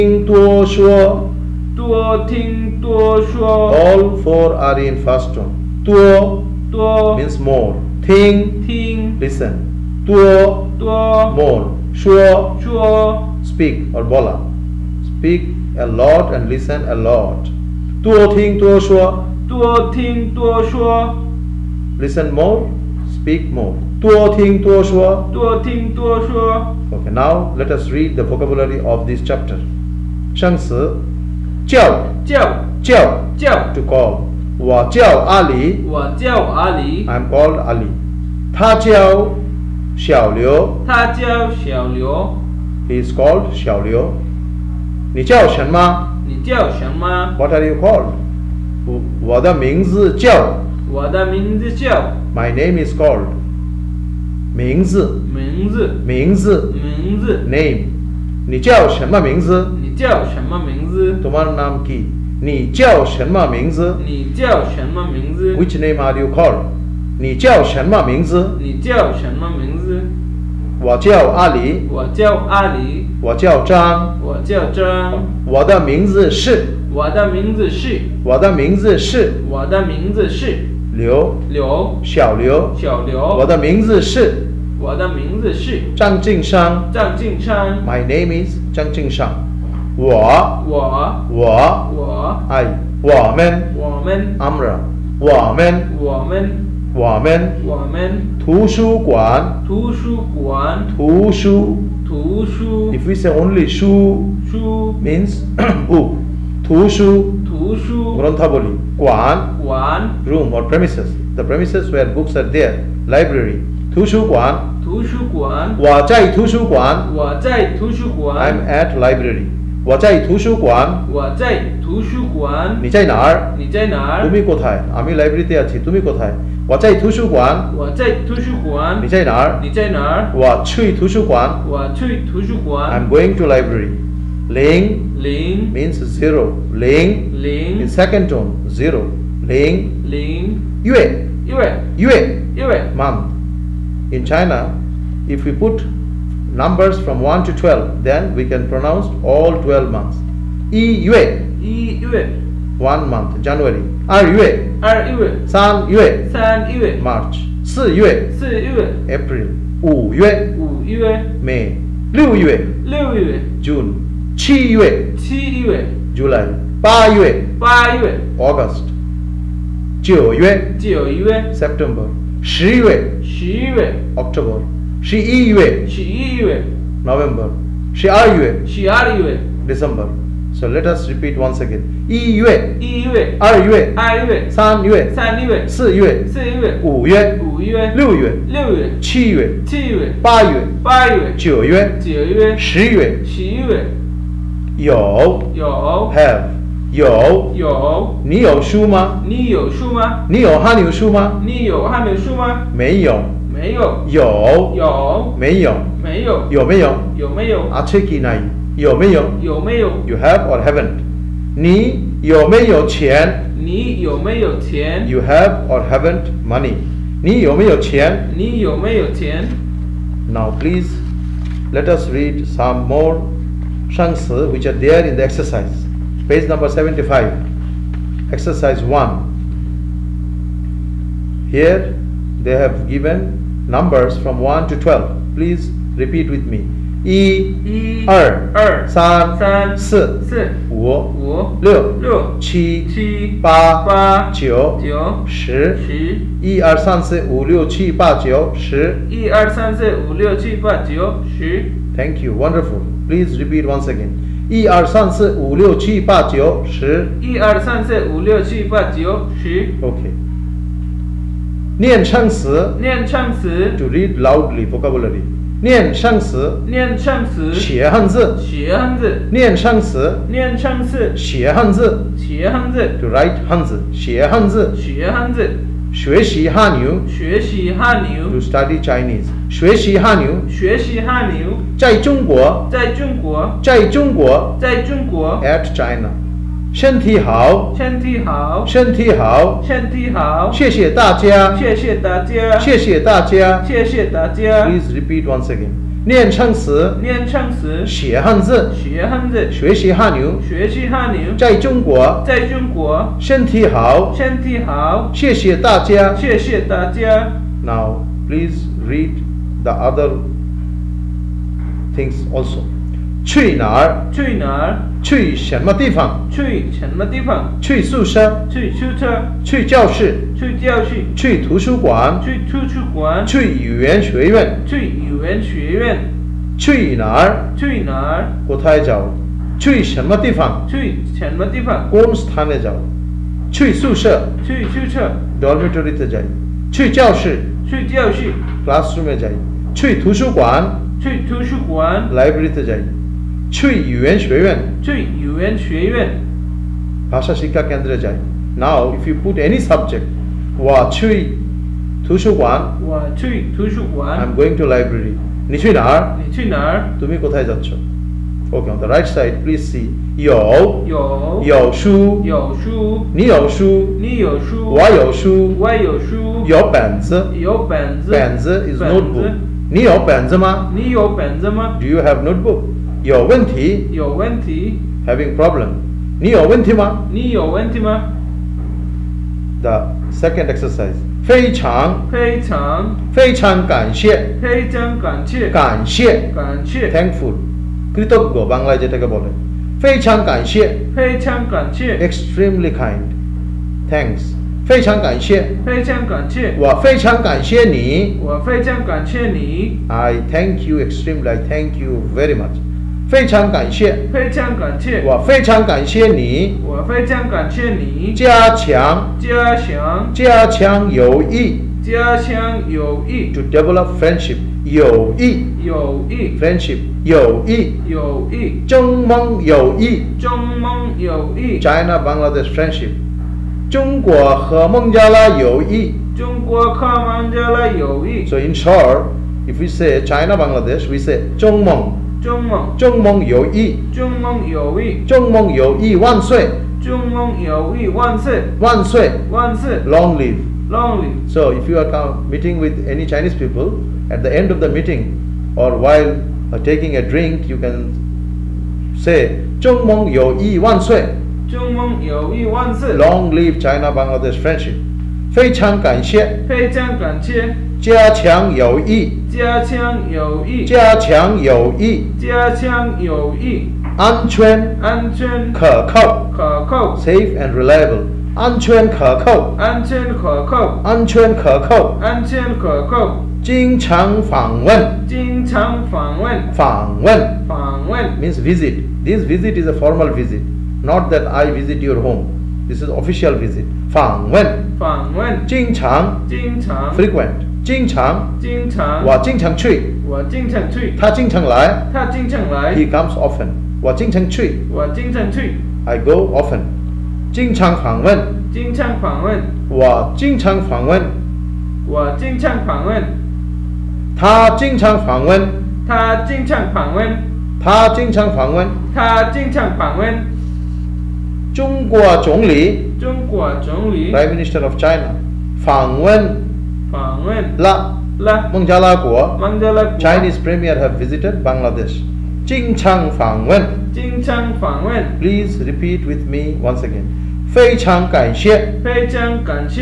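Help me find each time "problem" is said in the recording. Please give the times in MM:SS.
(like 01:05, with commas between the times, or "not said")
06:15.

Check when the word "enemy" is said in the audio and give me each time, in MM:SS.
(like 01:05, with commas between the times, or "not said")
not said.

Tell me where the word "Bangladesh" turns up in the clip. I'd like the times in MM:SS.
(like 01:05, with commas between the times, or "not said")
07:01, 07:10, 07:33.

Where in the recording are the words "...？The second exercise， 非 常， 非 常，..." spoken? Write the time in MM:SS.
06:19.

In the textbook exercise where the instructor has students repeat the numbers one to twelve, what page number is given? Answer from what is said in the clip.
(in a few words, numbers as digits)
75.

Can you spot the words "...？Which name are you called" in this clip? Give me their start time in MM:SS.
01:05.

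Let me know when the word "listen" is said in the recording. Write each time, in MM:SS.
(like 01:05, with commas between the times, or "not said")
00:09, 00:16, 00:21.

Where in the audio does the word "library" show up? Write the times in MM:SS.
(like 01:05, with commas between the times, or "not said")
01:53, 01:58, 02:05, 02:13.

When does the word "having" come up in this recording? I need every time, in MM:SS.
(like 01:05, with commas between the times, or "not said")
06:15.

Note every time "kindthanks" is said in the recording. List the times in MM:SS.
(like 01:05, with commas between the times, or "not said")
06:29.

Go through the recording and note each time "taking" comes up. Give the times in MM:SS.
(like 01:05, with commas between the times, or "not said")
07:26.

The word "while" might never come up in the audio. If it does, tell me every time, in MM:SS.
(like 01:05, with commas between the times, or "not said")
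07:25.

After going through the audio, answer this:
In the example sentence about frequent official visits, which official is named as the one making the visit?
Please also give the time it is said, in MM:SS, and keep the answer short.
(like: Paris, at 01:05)
Prime Minister of China, at 08:34.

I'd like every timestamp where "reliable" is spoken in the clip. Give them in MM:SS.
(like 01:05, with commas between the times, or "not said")
07:47.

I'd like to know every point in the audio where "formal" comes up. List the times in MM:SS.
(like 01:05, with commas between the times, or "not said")
07:59.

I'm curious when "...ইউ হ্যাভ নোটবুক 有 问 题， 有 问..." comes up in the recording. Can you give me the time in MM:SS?
06:11.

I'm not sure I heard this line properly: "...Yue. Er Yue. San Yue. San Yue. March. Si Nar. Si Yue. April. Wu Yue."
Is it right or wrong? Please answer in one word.
wrong.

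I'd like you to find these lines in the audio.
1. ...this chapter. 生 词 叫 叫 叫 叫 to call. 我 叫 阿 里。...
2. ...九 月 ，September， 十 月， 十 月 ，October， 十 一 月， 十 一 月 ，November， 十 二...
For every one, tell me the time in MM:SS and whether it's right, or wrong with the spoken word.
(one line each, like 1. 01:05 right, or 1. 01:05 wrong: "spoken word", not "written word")
1. 00:29 right
2. 02:50 right.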